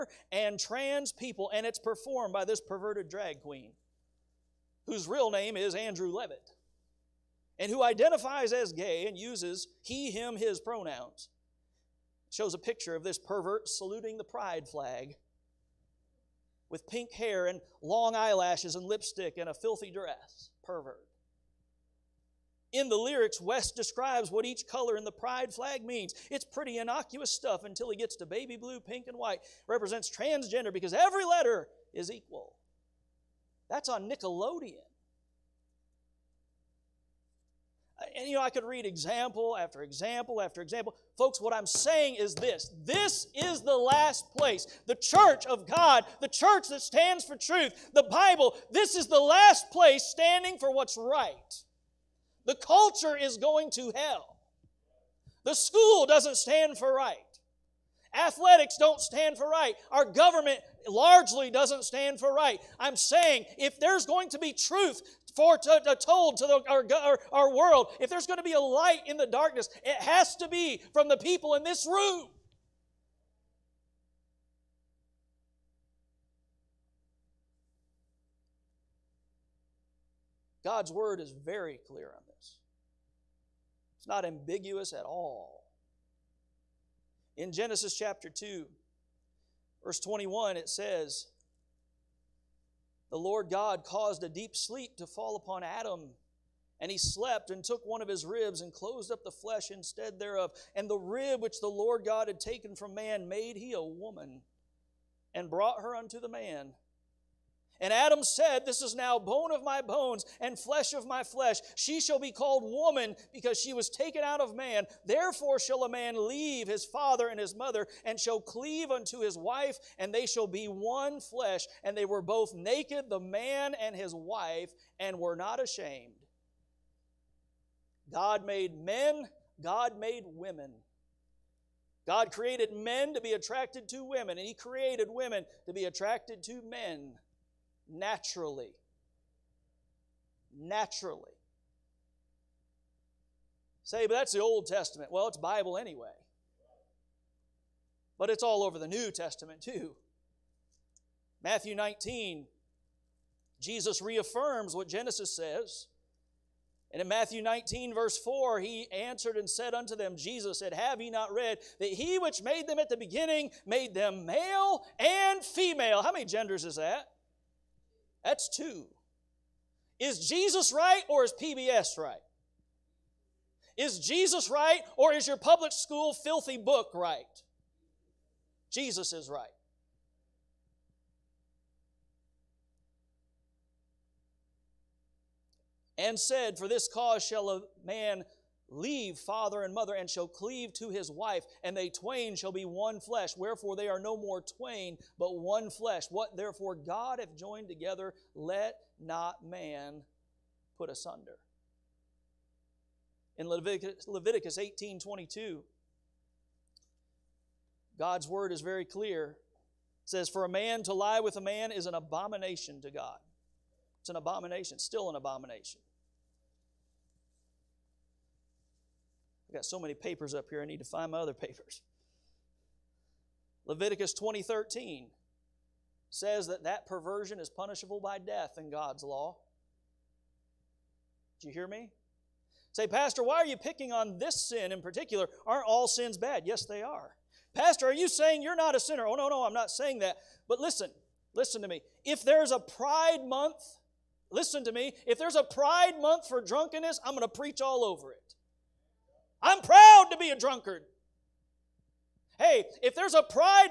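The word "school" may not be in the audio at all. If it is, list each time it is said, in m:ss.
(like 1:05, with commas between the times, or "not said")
0:55, 2:55.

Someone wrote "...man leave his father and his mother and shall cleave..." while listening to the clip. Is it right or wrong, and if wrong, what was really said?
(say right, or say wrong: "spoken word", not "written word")
right.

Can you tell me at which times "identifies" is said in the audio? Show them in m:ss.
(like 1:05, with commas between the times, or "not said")
0:07.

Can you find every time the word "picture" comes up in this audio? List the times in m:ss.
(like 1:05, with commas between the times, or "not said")
0:12.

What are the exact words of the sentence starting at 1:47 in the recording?
And Adam said, This is now bone of my bones and flesh of my flesh.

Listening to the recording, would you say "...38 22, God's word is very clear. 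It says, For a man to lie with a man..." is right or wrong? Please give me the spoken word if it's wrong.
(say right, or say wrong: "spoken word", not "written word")
wrong: "18", not "38".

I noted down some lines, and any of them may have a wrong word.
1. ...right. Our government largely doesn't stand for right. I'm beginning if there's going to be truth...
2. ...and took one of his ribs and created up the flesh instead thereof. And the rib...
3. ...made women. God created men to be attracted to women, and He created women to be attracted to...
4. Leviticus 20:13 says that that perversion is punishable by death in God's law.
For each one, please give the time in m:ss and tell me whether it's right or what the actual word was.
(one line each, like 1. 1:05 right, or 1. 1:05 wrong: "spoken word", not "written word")
1. 0:59 wrong: "saying", not "beginning"
2. 1:37 wrong: "closed", not "created"
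3. 2:09 right
4. 3:43 right.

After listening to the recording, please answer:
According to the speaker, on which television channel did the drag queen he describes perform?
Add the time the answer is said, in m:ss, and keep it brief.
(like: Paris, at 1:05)
Nickelodeon, at 0:34.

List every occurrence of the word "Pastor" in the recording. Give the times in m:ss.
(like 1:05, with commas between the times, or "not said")
3:52, 3:57.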